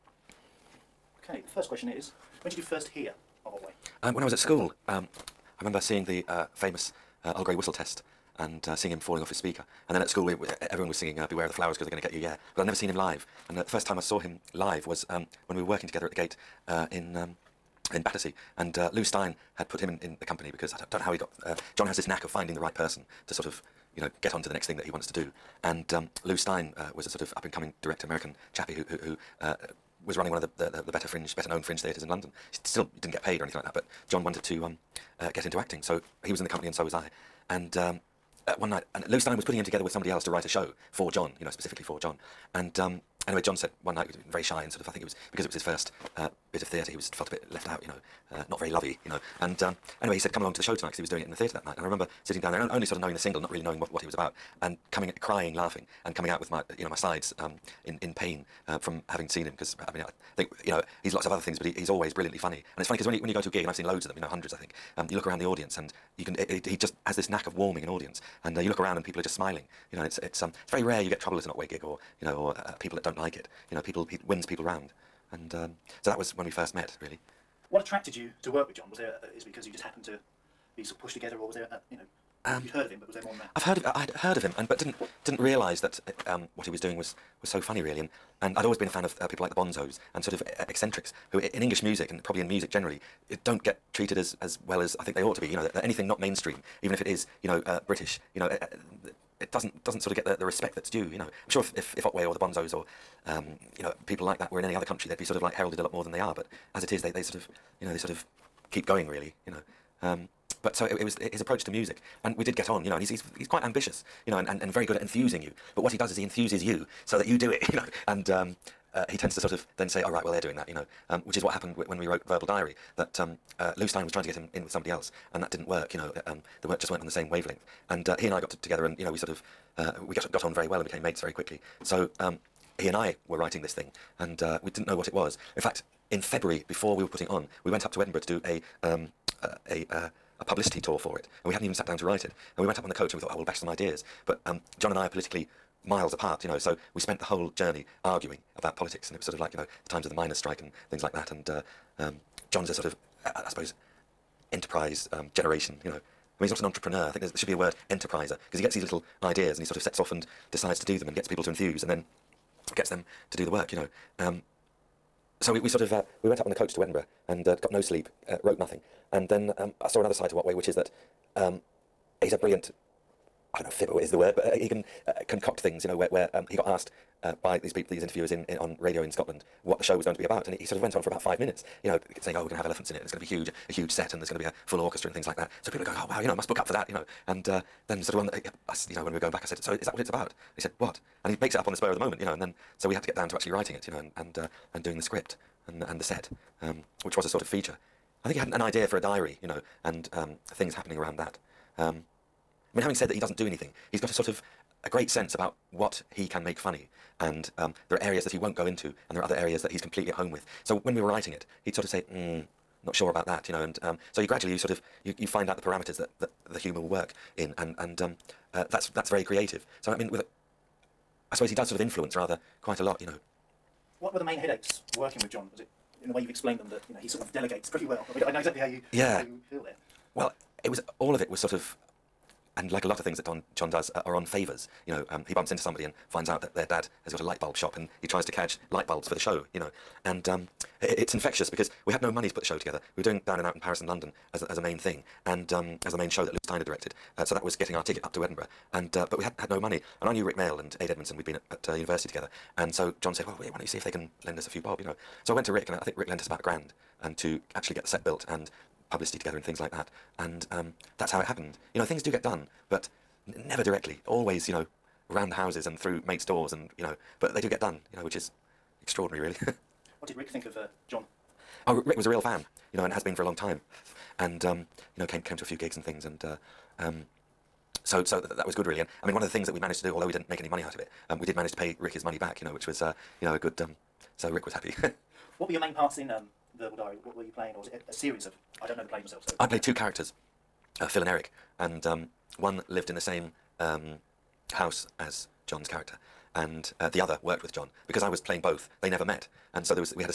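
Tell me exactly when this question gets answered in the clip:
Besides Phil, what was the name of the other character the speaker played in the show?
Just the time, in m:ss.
4:51.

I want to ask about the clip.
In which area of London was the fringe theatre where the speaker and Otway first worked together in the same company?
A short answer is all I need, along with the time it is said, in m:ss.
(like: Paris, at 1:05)
Battersea, at 0:18.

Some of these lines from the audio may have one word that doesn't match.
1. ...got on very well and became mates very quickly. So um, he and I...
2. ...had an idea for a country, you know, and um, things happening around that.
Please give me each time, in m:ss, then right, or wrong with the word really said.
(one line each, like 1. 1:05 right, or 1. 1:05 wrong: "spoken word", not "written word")
1. 2:10 right
2. 3:18 wrong: "diary", not "country".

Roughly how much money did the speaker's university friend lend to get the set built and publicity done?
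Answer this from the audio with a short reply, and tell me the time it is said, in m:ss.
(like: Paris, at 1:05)
about a grand, at 4:16.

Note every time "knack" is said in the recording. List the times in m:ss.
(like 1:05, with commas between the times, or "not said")
0:22, 1:07.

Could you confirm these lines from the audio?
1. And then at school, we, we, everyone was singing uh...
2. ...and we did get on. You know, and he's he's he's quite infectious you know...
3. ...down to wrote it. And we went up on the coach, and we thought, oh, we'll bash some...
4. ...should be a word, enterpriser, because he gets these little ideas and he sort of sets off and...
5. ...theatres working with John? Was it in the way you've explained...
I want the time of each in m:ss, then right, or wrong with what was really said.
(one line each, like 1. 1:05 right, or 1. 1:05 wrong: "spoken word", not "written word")
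1. 0:09 right
2. 1:52 wrong: "ambitious", not "infectious"
3. 2:21 wrong: "write", not "wrote"
4. 2:37 right
5. 3:44 wrong: "headaches", not "theatres".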